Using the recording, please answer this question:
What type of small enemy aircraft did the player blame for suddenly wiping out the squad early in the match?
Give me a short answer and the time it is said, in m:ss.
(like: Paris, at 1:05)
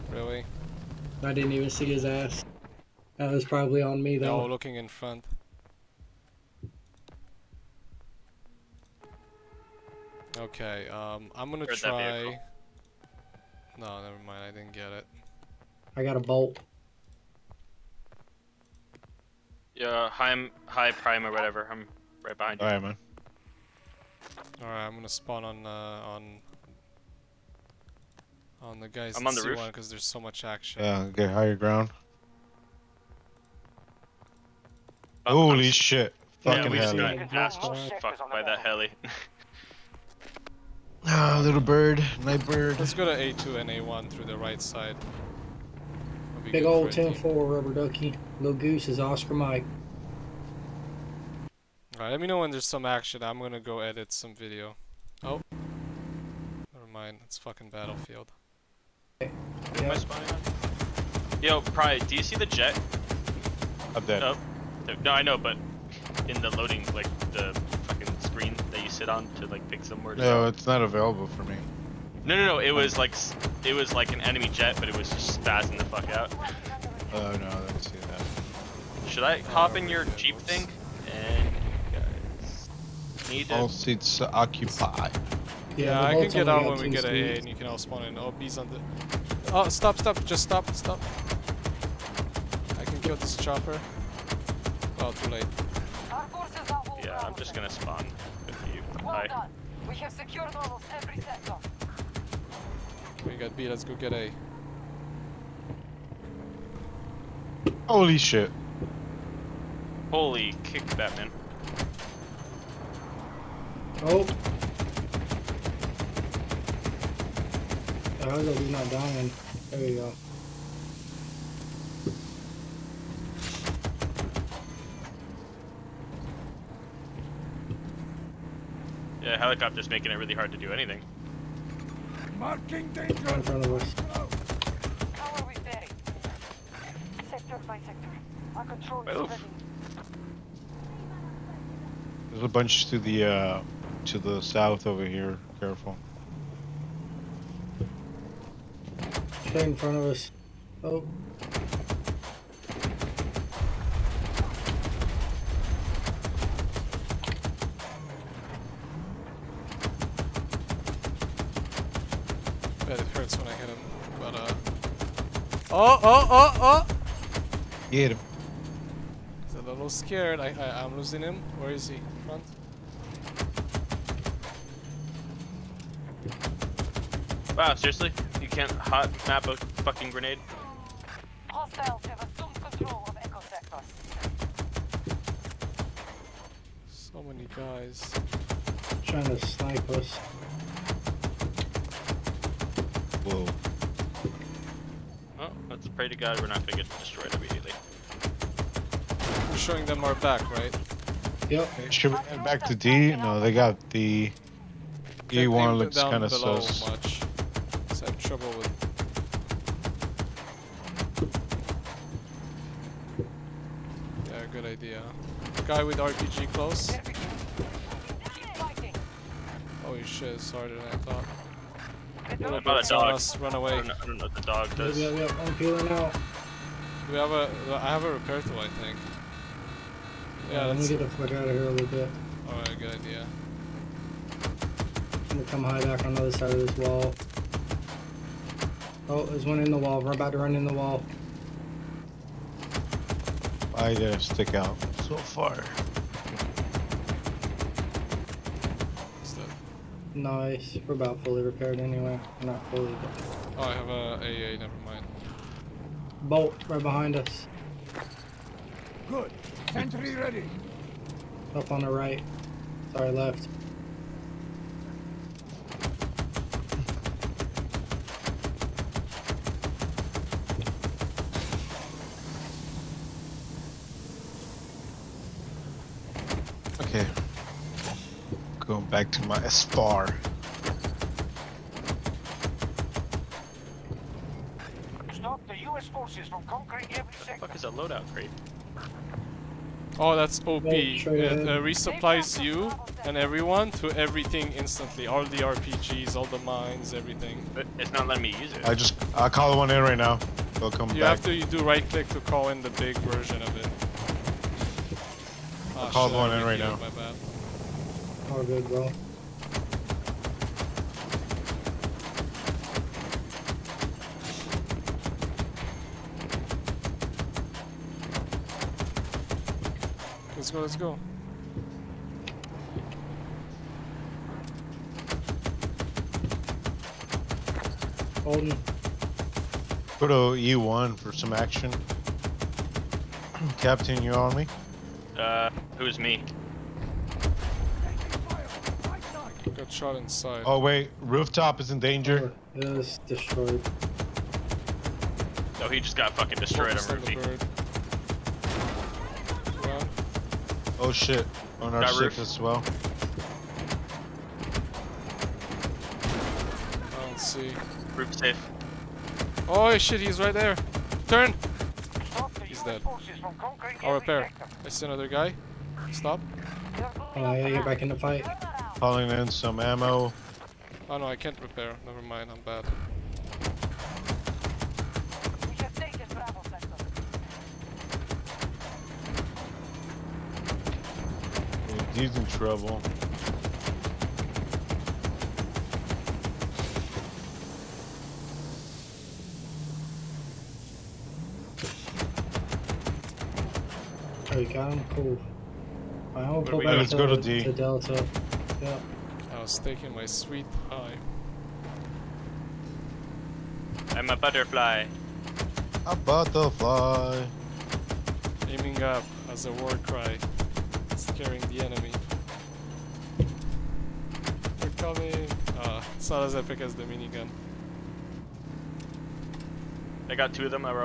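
little bird, at 0:41.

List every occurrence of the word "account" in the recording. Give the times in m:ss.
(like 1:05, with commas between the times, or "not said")
not said.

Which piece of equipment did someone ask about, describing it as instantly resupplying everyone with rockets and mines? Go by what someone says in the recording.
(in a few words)
loadout crate.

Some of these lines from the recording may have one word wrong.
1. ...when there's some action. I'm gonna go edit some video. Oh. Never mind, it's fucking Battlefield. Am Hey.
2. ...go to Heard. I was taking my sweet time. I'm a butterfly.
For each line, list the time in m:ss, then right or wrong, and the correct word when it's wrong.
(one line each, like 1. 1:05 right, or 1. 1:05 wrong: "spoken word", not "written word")
1. 0:52 right
2. 6:36 wrong: "Delta", not "Heard".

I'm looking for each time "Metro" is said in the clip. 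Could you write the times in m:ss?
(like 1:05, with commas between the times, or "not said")
not said.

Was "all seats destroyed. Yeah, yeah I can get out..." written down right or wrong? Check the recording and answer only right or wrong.
wrong.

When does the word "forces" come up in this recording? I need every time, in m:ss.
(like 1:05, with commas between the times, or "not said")
4:45.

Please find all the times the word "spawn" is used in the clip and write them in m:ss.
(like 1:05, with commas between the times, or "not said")
0:25, 1:27, 1:37.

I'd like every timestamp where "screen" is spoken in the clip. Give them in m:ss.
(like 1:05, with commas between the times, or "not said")
1:08.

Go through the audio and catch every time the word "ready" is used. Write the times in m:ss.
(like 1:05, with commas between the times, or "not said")
2:19, 4:20.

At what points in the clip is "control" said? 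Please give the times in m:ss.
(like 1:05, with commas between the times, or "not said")
2:18, 3:02.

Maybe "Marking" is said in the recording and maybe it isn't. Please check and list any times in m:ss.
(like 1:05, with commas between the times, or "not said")
2:12.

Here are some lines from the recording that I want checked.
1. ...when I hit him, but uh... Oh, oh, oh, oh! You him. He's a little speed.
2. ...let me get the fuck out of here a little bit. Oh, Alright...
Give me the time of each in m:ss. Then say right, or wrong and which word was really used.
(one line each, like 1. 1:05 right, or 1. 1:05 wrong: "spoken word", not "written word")
1. 2:43 wrong: "scared", not "speed"
2. 3:50 right.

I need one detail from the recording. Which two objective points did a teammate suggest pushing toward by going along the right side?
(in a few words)
A2 and A1.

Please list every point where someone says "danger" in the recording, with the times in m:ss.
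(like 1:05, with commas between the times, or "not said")
2:12, 5:41.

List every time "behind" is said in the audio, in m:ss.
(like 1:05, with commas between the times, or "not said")
0:22, 4:16.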